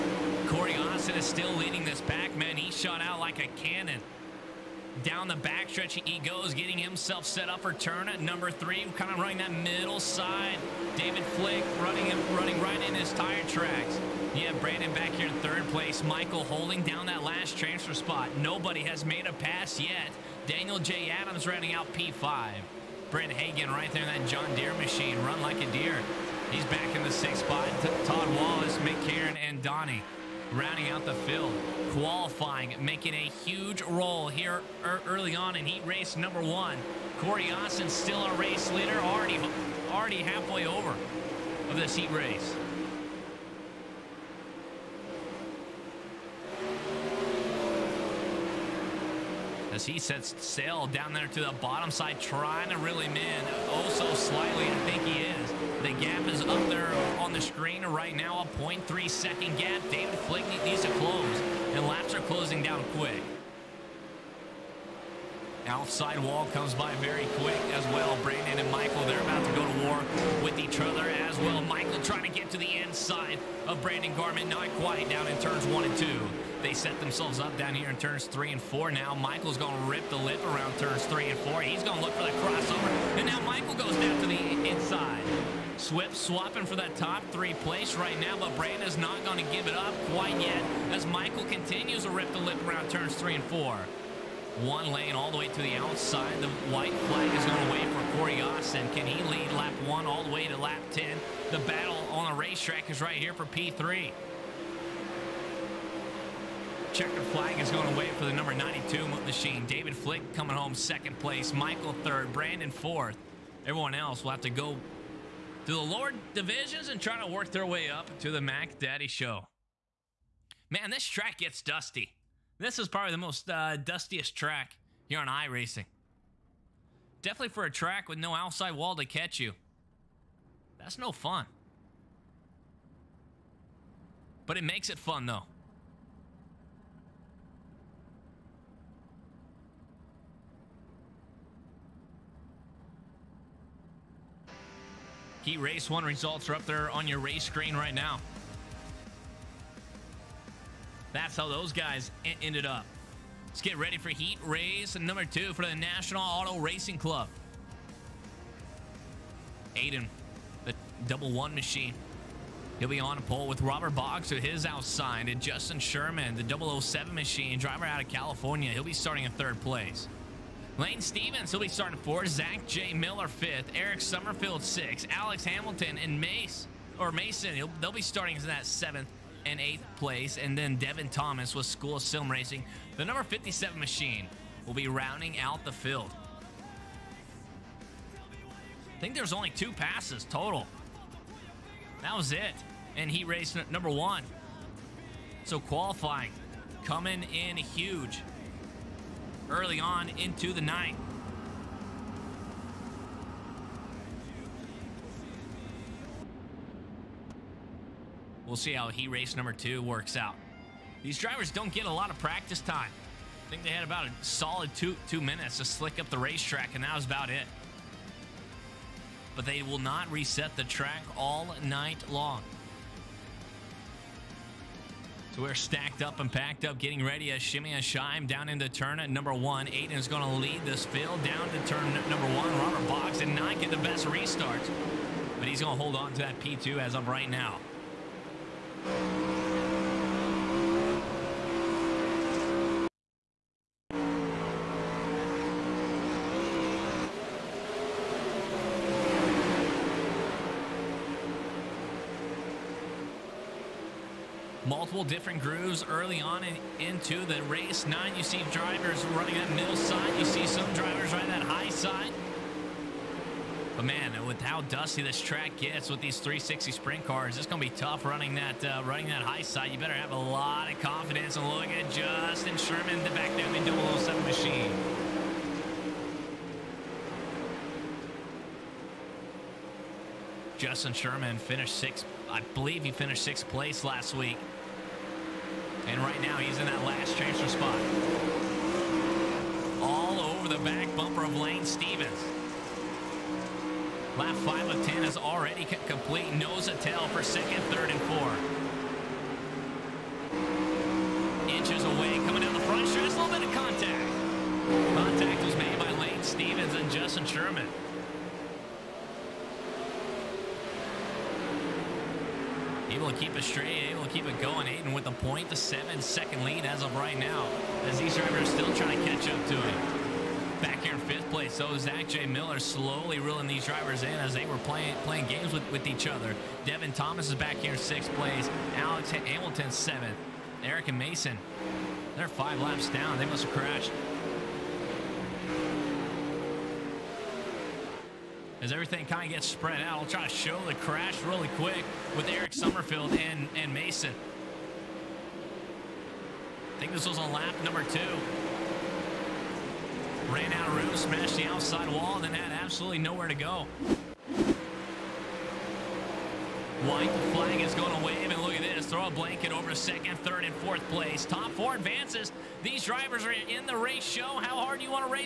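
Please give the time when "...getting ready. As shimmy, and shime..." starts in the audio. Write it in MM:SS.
03:46.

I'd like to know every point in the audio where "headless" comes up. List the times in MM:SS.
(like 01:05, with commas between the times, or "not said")
not said.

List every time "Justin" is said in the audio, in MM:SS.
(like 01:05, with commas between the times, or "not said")
02:45, 04:31, 04:40, 05:06.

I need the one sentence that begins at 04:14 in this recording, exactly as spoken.
multiple different grooves early on in, into the race.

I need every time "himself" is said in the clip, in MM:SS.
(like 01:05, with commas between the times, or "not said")
00:06.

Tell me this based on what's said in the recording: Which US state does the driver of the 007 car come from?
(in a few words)
California.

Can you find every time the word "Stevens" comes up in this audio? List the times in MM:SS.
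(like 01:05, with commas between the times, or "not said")
02:51, 04:51, 05:06.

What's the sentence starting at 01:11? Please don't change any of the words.
Michael trying to get to the inside of Brandon Garman, not quite down in turns one and two.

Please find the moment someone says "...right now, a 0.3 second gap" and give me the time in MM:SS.
00:57.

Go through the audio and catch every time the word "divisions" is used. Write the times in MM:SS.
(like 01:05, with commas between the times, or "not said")
01:56.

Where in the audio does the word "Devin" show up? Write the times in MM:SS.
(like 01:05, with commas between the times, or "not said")
03:00, 05:26.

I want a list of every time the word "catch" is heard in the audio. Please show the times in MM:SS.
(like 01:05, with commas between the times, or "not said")
02:09, 05:19.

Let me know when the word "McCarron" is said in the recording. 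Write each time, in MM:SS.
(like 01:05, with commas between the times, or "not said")
00:28.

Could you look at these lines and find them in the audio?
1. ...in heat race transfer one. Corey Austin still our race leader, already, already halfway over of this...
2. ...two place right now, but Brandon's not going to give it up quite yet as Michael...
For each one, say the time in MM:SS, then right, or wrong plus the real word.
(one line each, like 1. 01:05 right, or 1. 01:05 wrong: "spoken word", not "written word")
1. 00:35 wrong: "number", not "transfer"
2. 01:27 wrong: "three", not "two".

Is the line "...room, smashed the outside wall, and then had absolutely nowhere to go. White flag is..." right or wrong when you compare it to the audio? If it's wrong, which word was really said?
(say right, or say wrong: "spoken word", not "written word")
right.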